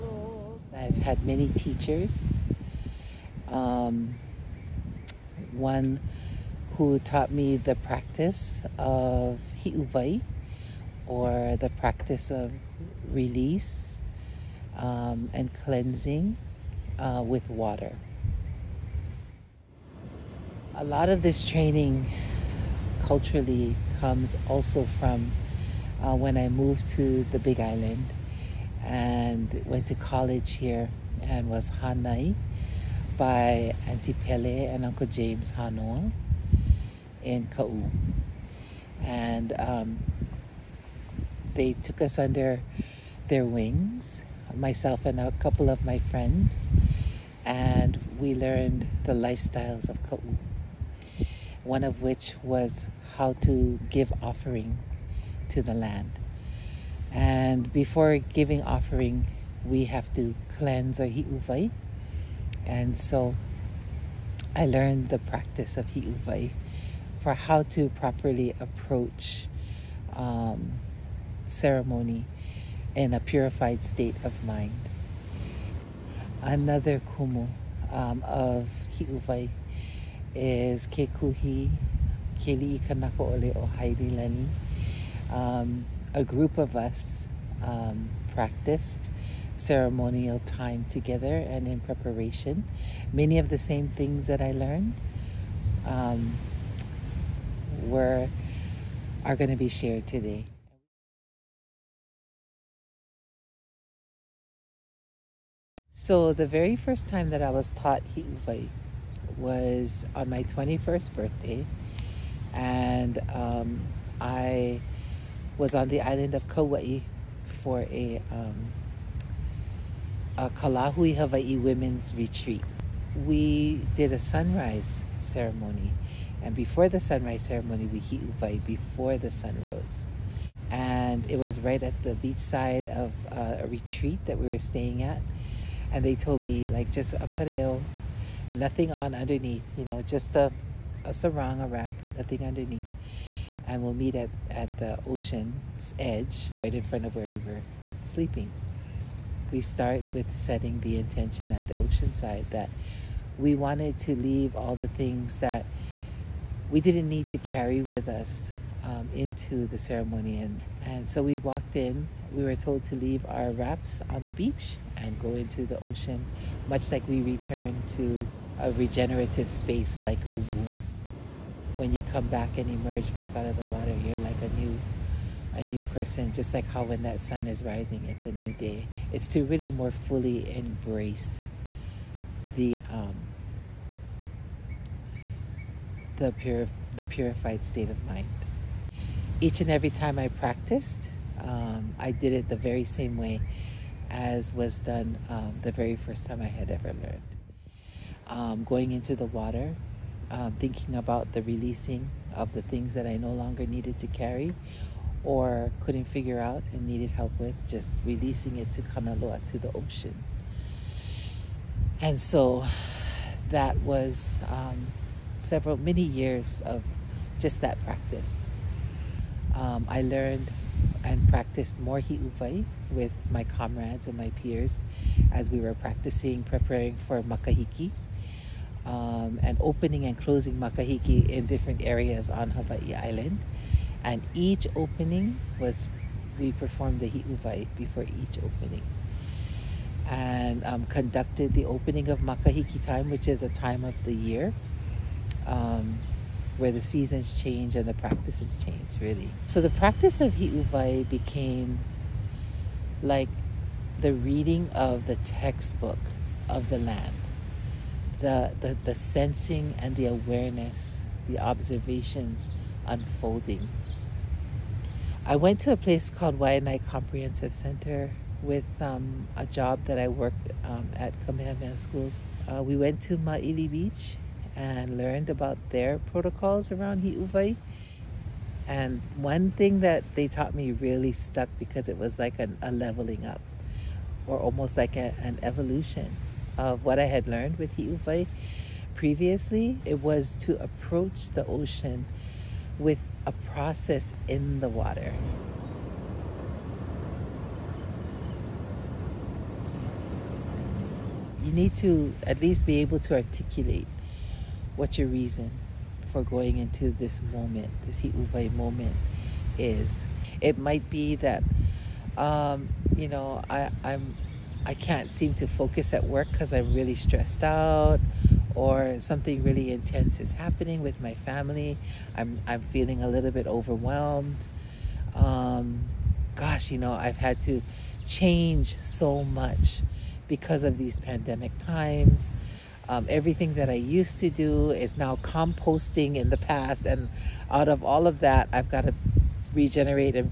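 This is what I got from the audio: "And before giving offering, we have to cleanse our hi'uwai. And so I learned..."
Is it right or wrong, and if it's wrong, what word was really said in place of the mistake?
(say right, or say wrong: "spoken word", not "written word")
right.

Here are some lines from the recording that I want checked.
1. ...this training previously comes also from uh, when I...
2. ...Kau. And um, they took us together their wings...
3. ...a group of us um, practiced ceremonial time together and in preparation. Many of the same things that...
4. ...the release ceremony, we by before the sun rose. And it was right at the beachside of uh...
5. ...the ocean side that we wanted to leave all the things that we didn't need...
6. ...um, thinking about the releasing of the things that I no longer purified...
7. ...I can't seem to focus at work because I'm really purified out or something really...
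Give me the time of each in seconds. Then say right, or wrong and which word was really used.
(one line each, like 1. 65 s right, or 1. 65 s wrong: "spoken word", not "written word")
1. 21 s wrong: "culturally", not "previously"
2. 37 s wrong: "under", not "together"
3. 86 s right
4. 126 s wrong: "sunrise", not "release"
5. 151 s right
6. 200 s wrong: "needed", not "purified"
7. 314 s wrong: "stressed", not "purified".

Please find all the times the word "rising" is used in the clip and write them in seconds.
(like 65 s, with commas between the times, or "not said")
177 s.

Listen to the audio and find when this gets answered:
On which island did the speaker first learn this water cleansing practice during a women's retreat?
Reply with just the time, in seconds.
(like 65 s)
116 s.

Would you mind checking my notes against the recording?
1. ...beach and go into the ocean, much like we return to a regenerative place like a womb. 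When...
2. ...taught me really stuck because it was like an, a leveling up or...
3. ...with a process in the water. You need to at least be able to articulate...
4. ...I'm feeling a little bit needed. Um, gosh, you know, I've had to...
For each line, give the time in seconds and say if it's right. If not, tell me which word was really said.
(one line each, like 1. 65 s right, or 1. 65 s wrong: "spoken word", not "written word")
1. 164 s wrong: "space", not "place"
2. 280 s right
3. 292 s right
4. 322 s wrong: "overwhelmed", not "needed".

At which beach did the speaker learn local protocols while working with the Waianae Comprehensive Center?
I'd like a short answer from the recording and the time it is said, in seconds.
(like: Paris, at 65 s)
Ma'ili Beach, at 273 s.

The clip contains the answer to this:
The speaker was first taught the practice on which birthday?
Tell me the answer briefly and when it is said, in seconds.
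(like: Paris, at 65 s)
21st, at 110 s.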